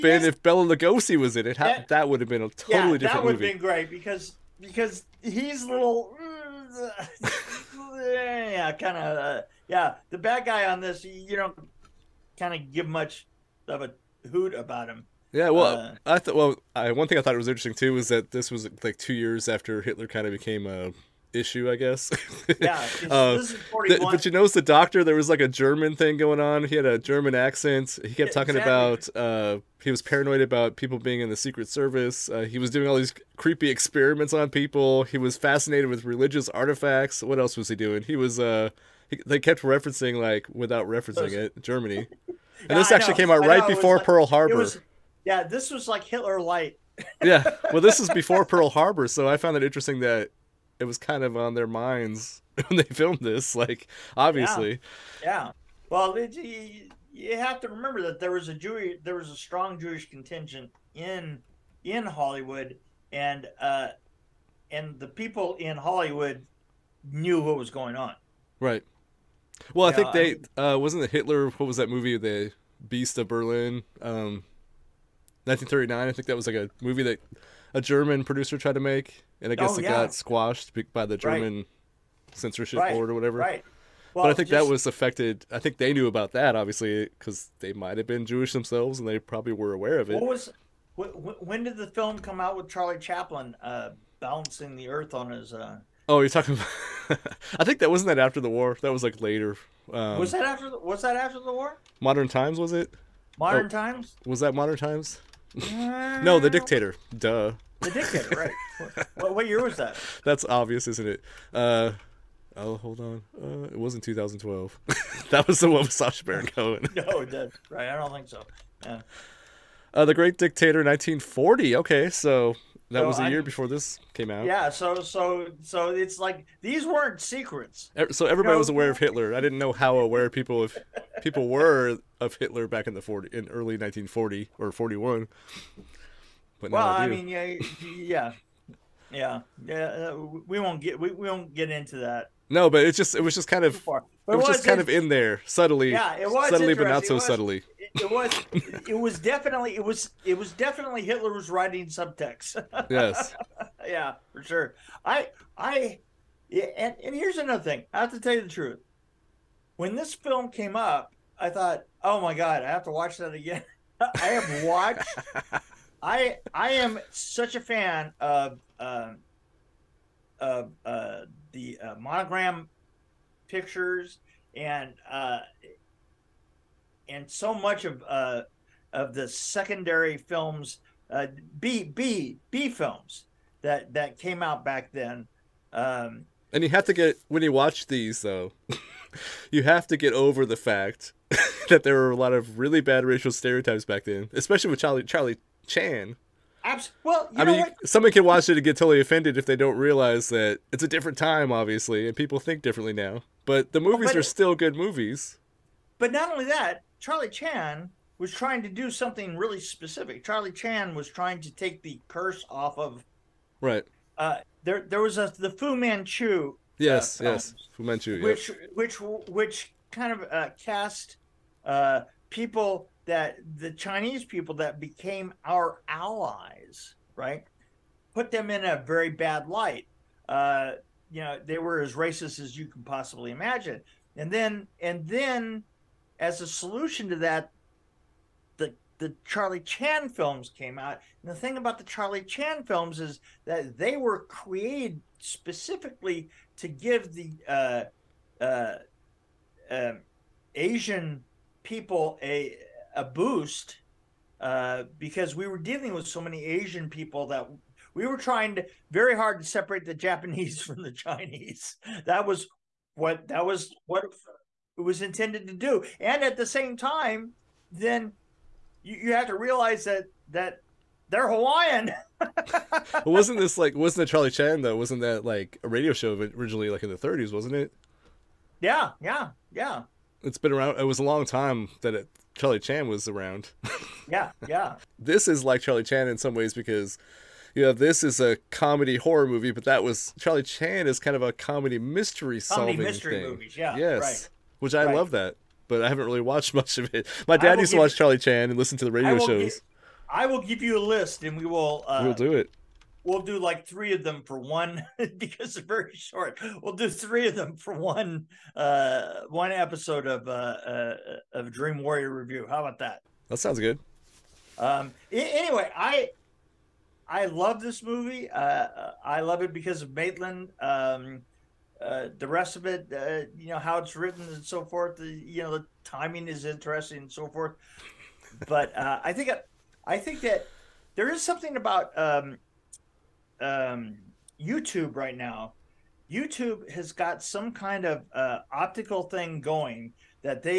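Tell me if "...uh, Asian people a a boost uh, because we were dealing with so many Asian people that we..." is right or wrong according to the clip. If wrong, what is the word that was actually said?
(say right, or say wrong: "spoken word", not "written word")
right.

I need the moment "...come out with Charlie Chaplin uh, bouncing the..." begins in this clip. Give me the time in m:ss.
1:32.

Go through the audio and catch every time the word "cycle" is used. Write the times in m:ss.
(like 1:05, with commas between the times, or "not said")
not said.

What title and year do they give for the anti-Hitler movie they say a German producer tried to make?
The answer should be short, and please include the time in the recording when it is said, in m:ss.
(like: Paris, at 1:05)
The Beast of Berlin, 1939, at 1:12.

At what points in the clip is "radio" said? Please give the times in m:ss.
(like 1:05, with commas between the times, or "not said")
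4:35, 4:58.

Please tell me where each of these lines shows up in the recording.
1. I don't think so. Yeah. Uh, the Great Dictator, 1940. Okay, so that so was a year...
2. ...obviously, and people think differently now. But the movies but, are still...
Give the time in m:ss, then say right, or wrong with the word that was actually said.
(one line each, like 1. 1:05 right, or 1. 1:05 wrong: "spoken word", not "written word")
1. 1:57 right
2. 3:21 right.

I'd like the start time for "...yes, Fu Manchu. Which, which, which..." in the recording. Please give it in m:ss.
3:37.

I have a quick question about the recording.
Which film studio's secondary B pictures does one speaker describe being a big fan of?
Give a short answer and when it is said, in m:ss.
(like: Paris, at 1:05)
Monogram Pictures, at 2:51.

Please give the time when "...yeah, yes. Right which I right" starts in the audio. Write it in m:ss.
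4:53.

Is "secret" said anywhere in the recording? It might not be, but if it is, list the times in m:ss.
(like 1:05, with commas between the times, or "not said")
0:31, 2:07.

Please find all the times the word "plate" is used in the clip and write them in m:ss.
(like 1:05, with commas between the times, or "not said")
not said.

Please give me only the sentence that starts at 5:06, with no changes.
We'll do three of them for one uh, one episode of uh, uh, of Dream Warrior review.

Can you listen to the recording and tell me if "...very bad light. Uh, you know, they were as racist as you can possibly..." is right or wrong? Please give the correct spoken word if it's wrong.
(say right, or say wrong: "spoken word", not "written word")
right.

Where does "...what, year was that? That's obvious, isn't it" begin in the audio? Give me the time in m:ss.
1:49.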